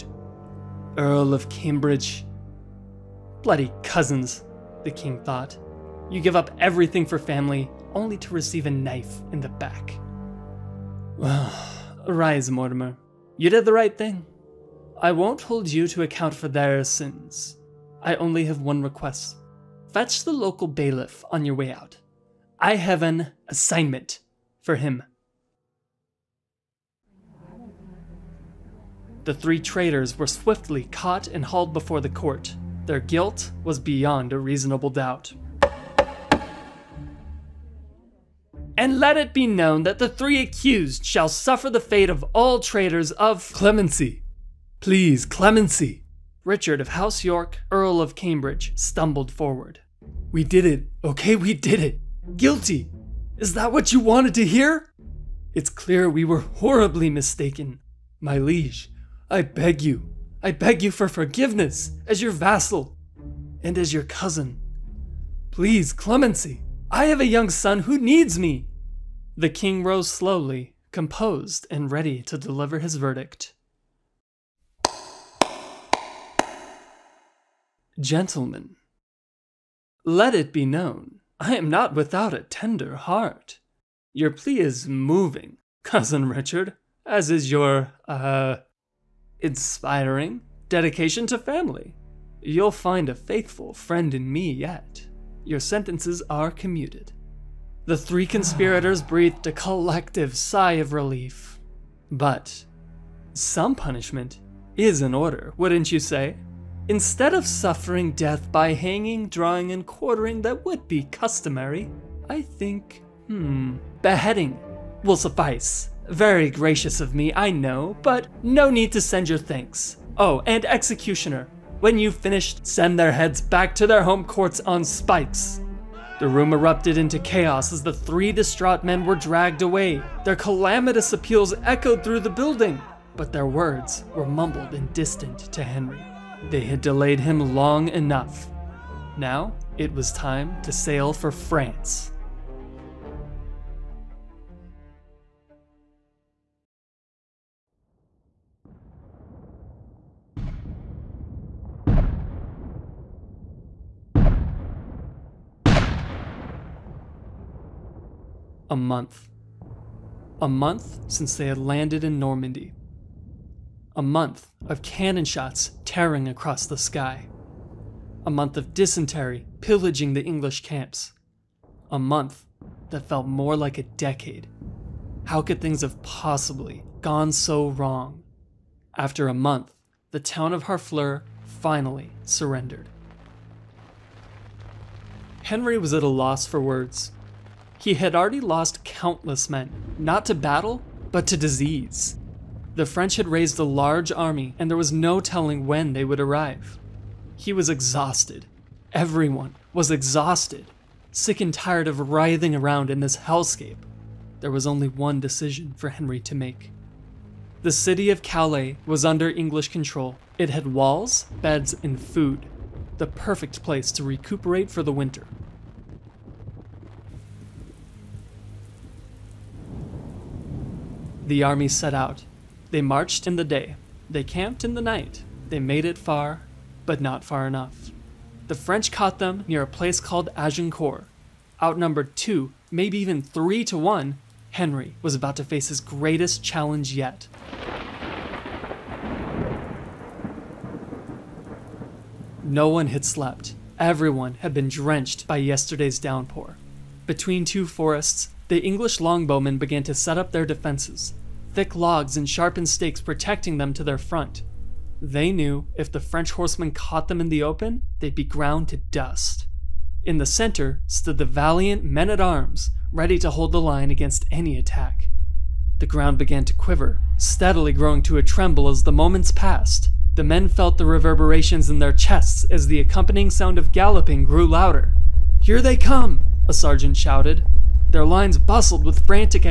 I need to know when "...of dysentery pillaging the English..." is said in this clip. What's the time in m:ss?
2:48.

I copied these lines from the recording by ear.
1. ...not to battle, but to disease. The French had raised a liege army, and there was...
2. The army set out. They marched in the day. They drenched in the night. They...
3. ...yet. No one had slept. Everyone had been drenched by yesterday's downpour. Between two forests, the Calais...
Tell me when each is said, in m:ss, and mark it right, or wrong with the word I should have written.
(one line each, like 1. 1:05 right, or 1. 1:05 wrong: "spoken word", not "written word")
1. 3:09 wrong: "large", not "liege"
2. 3:41 wrong: "camped", not "drenched"
3. 3:56 wrong: "English", not "Calais".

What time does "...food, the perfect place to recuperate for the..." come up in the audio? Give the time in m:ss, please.
3:31.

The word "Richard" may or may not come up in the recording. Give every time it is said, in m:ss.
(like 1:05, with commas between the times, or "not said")
0:46, 1:26.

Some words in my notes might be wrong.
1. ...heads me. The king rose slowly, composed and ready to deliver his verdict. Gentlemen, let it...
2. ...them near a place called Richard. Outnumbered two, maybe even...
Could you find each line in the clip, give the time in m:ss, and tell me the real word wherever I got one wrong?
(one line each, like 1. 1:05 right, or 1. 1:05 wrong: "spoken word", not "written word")
1. 1:07 wrong: "needs", not "heads"
2. 3:49 wrong: "Agincourt", not "Richard".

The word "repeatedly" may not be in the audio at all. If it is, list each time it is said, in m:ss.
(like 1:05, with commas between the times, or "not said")
not said.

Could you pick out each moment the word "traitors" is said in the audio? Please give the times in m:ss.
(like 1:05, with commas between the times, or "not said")
0:29, 0:42.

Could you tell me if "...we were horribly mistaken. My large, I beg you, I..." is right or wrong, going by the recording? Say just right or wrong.
wrong.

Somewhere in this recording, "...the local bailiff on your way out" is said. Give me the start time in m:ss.
0:20.